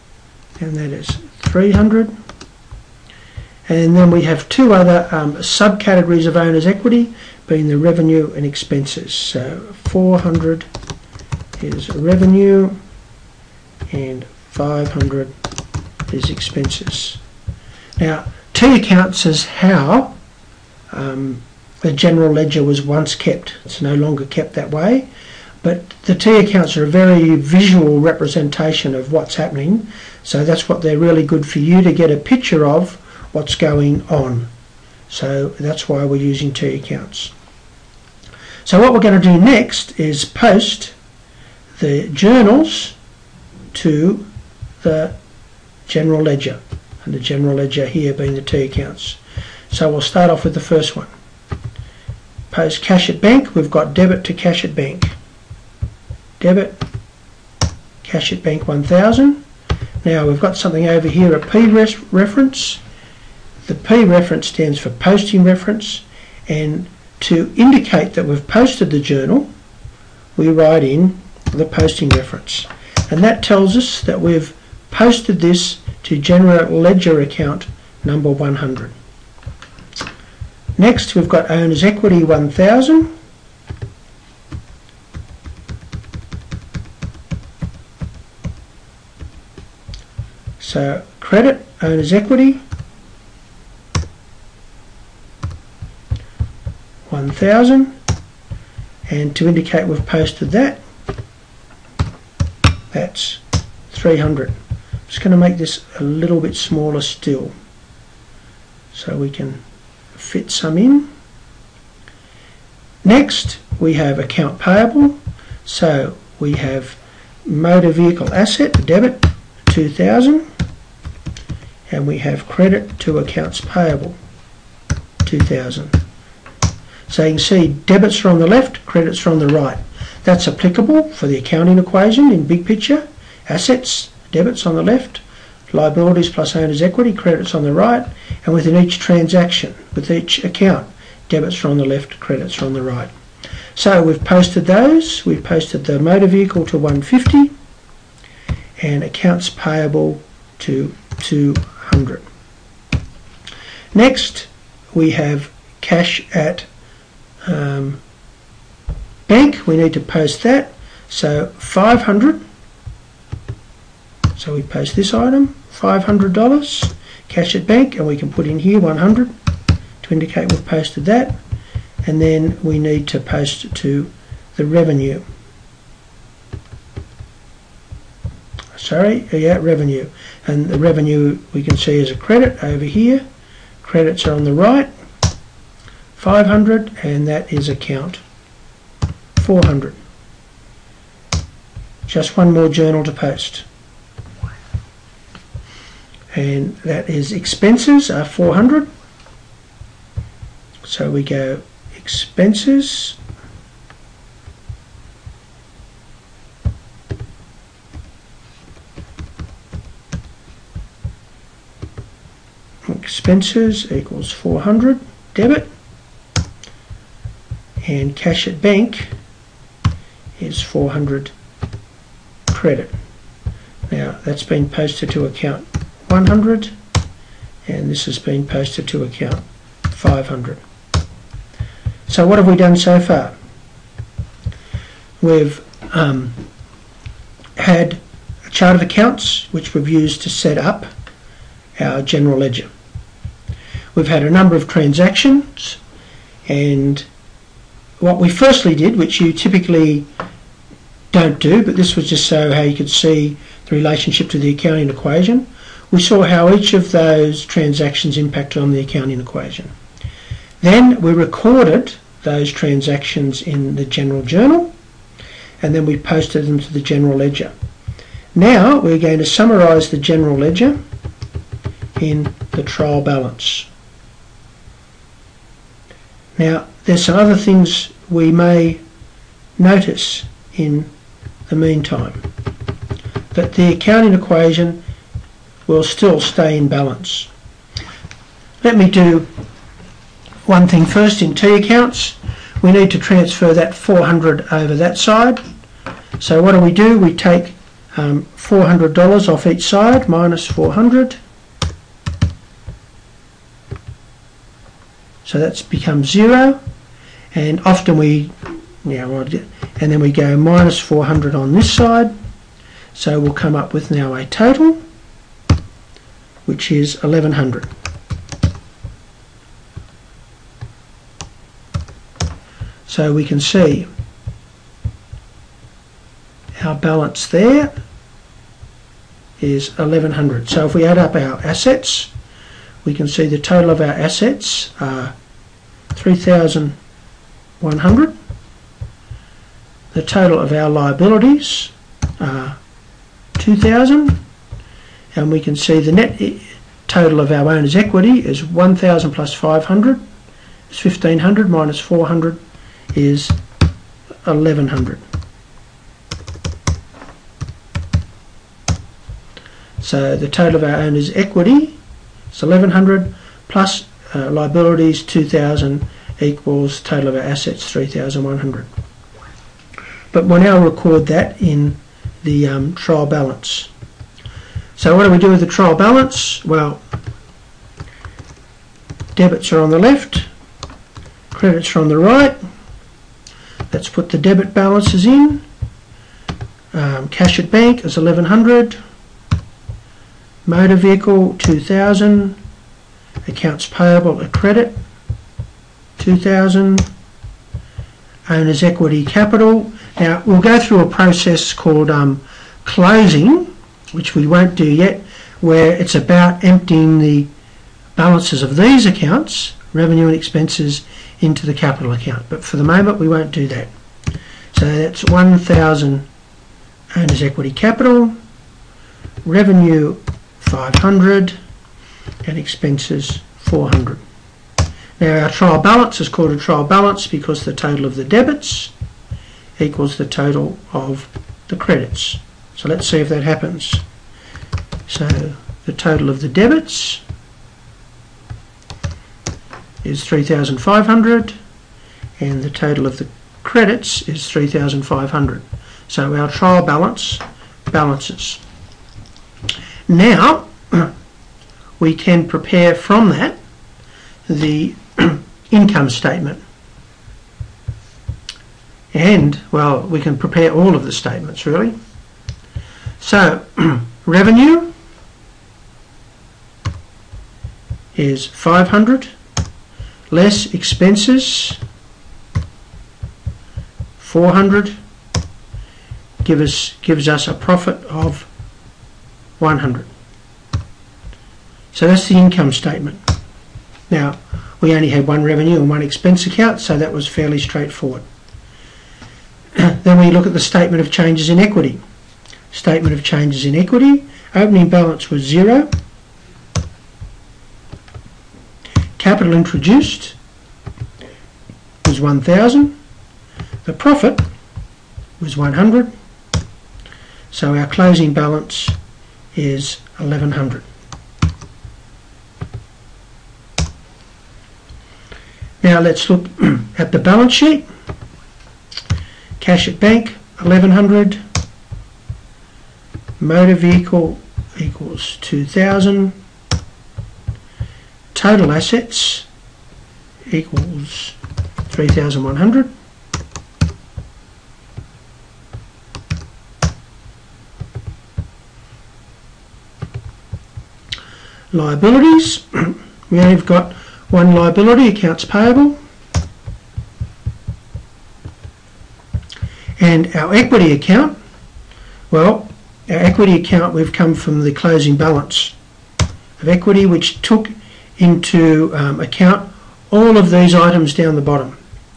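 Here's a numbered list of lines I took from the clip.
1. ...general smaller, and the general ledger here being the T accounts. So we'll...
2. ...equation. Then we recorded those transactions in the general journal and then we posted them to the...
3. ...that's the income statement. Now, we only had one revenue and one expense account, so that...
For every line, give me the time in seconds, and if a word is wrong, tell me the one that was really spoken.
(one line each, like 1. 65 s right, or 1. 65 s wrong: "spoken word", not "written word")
1. 45 s wrong: "ledger", not "smaller"
2. 259 s right
3. 481 s right.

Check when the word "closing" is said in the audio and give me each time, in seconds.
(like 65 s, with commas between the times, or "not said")
402 s, 507 s, 554 s.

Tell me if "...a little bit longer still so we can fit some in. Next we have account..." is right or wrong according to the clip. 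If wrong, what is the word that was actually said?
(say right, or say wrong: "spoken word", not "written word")
wrong: "smaller", not "longer".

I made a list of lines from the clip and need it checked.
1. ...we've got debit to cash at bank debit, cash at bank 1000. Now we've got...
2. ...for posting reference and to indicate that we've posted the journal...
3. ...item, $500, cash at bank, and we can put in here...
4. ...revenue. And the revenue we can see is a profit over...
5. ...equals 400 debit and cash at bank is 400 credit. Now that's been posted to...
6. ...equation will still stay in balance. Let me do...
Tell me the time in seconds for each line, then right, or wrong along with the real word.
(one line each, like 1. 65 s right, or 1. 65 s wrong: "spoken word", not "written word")
1. 53 s right
2. 64 s right
3. 165 s right
4. 179 s wrong: "credit", not "profit"
5. 213 s right
6. 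284 s right.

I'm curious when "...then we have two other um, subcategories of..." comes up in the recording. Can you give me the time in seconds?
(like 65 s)
3 s.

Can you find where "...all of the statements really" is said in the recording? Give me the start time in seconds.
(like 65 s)
460 s.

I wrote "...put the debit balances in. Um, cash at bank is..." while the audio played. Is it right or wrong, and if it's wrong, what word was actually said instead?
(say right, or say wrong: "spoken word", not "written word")
right.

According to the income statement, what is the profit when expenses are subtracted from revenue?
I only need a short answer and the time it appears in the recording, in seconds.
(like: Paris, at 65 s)
100, at 477 s.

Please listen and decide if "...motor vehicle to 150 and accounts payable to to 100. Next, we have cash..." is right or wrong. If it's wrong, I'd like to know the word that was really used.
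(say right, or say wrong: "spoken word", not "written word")
right.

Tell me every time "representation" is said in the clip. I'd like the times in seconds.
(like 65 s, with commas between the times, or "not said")
27 s.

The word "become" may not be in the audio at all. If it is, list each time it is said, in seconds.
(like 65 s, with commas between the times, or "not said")
305 s.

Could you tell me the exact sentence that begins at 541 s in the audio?
Liabilities, we only have got one liability, accounts payable.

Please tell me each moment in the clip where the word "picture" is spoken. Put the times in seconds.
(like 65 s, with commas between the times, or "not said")
32 s, 132 s.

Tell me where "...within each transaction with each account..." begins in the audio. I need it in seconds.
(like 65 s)
138 s.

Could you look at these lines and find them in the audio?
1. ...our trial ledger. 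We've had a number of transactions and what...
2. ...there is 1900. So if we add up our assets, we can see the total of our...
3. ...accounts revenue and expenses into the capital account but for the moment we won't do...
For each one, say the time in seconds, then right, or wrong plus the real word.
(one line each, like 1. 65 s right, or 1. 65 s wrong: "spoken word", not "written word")
1. 241 s wrong: "general", not "trial"
2. 327 s wrong: "1100", not "1900"
3. 408 s right.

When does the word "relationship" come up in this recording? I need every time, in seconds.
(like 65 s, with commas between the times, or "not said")
253 s.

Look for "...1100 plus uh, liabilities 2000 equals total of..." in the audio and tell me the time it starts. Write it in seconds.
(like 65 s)
362 s.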